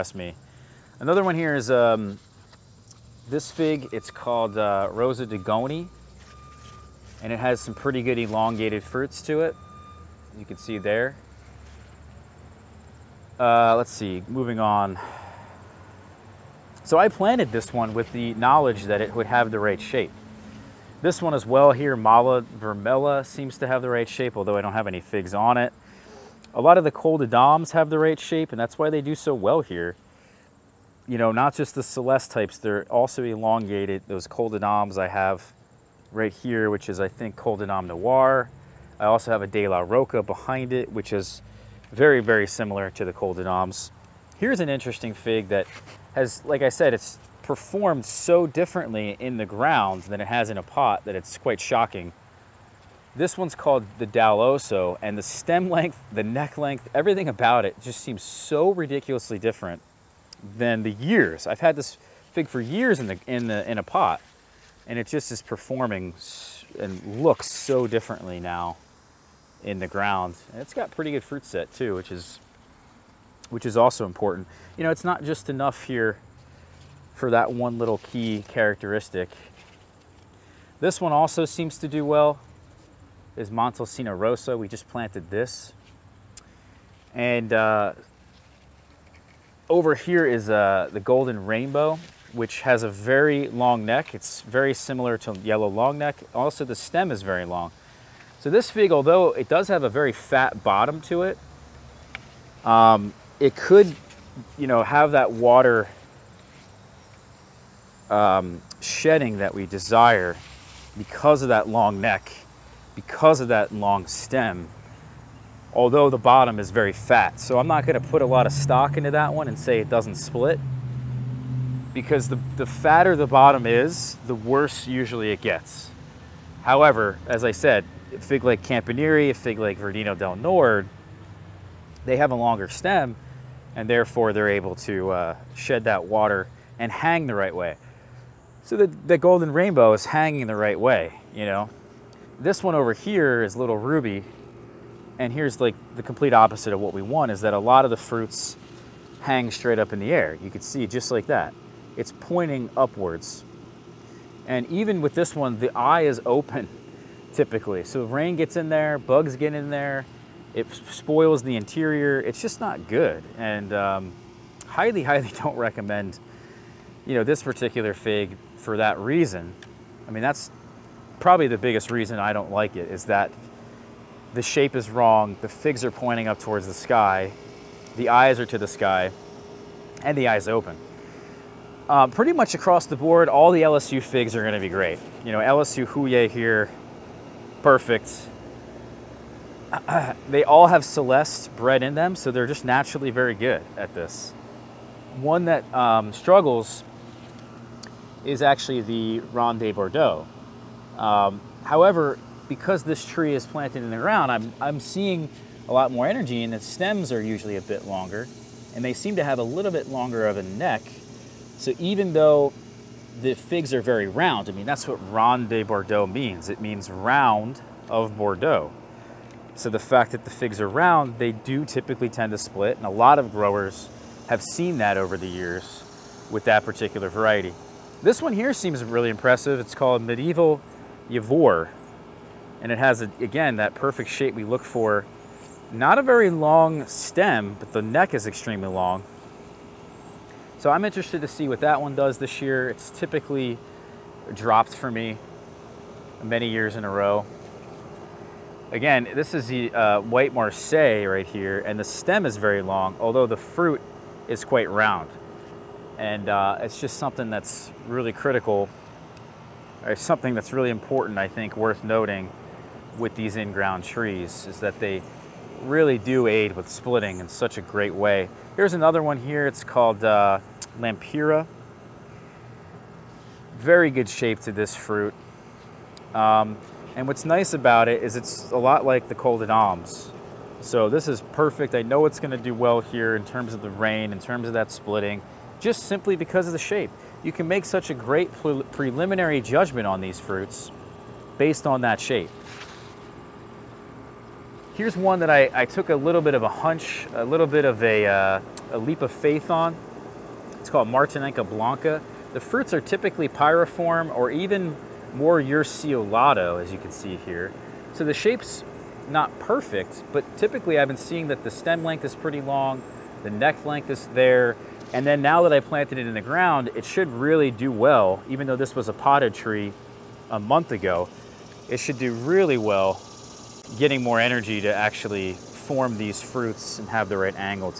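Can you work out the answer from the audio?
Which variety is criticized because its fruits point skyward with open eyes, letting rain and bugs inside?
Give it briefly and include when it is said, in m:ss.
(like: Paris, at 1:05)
Little Ruby, at 2:23.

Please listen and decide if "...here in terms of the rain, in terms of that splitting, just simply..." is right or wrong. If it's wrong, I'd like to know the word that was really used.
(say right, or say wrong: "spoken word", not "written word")
right.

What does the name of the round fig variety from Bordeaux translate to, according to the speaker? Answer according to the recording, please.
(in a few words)
round of Bordeaux.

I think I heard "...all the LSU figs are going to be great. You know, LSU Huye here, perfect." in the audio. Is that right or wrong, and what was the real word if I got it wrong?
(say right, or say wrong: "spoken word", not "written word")
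right.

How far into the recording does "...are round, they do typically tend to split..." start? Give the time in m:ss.
3:40.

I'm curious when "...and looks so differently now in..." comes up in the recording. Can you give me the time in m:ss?
1:06.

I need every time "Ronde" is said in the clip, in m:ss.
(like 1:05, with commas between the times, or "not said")
3:19, 3:35.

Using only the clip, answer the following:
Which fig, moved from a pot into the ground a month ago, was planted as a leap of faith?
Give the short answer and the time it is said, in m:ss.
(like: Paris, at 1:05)
Martinica Blanca, at 5:00.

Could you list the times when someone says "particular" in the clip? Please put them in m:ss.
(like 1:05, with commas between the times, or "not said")
2:47, 3:46.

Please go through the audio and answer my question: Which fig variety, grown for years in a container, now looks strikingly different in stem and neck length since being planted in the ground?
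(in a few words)
Daloso.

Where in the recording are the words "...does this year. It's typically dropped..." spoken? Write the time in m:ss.
4:01.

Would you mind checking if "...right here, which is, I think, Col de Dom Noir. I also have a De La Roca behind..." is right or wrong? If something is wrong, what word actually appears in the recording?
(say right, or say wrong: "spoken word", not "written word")
right.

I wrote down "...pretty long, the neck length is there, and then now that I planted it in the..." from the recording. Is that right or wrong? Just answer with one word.
right.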